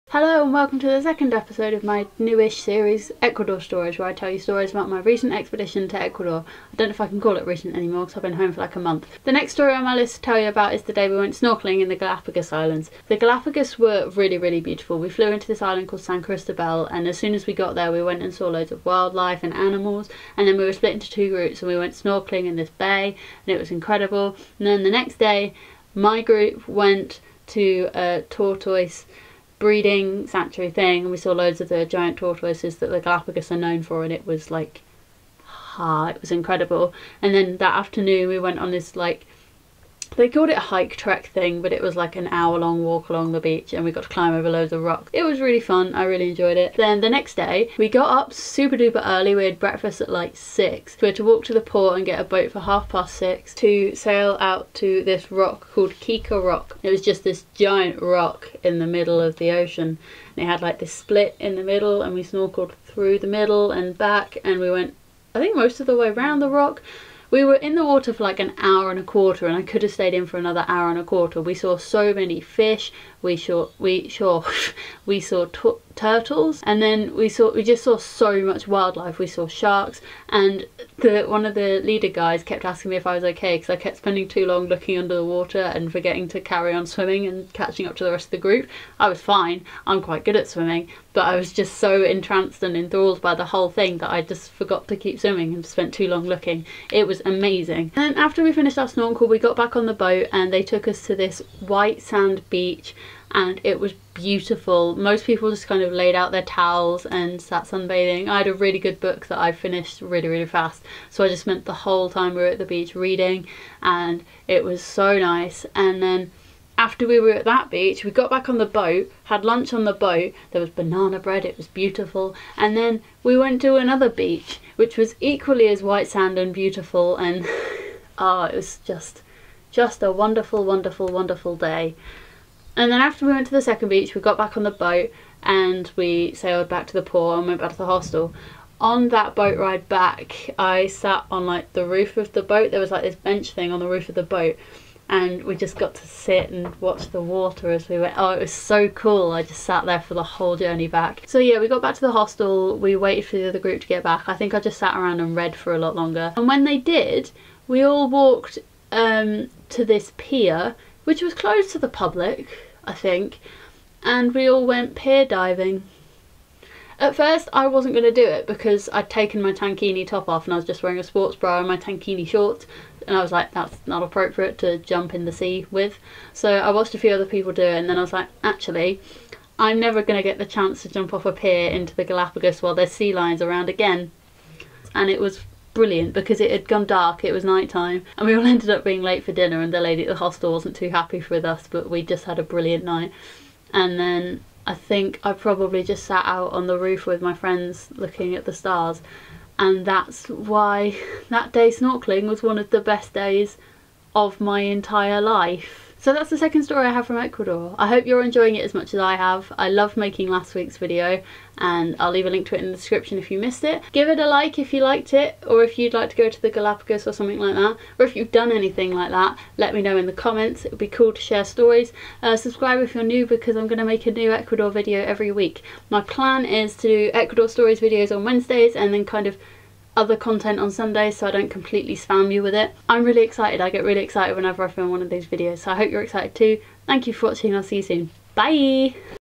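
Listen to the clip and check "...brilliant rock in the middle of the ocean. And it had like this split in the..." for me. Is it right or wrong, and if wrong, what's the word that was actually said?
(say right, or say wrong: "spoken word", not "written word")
wrong: "giant", not "brilliant".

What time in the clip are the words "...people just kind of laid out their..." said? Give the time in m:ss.
1:45.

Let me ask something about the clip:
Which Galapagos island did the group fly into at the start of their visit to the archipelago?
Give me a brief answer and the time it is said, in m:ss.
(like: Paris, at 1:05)
San Cristobal, at 0:16.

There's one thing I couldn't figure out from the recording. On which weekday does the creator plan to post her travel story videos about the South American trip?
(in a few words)
Wednesdays.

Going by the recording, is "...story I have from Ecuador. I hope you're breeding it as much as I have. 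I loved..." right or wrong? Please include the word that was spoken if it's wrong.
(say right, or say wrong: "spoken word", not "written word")
wrong: "enjoying", not "breeding".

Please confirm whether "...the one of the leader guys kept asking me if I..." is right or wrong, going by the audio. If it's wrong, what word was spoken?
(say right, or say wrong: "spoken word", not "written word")
right.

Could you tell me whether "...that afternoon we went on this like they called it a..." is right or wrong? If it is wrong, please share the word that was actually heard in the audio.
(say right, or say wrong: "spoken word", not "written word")
right.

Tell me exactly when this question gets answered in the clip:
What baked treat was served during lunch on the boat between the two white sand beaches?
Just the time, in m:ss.
2:00.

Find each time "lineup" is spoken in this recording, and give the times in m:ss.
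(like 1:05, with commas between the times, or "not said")
not said.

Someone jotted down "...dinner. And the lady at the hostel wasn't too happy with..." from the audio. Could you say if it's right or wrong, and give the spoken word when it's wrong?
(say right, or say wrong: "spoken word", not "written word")
right.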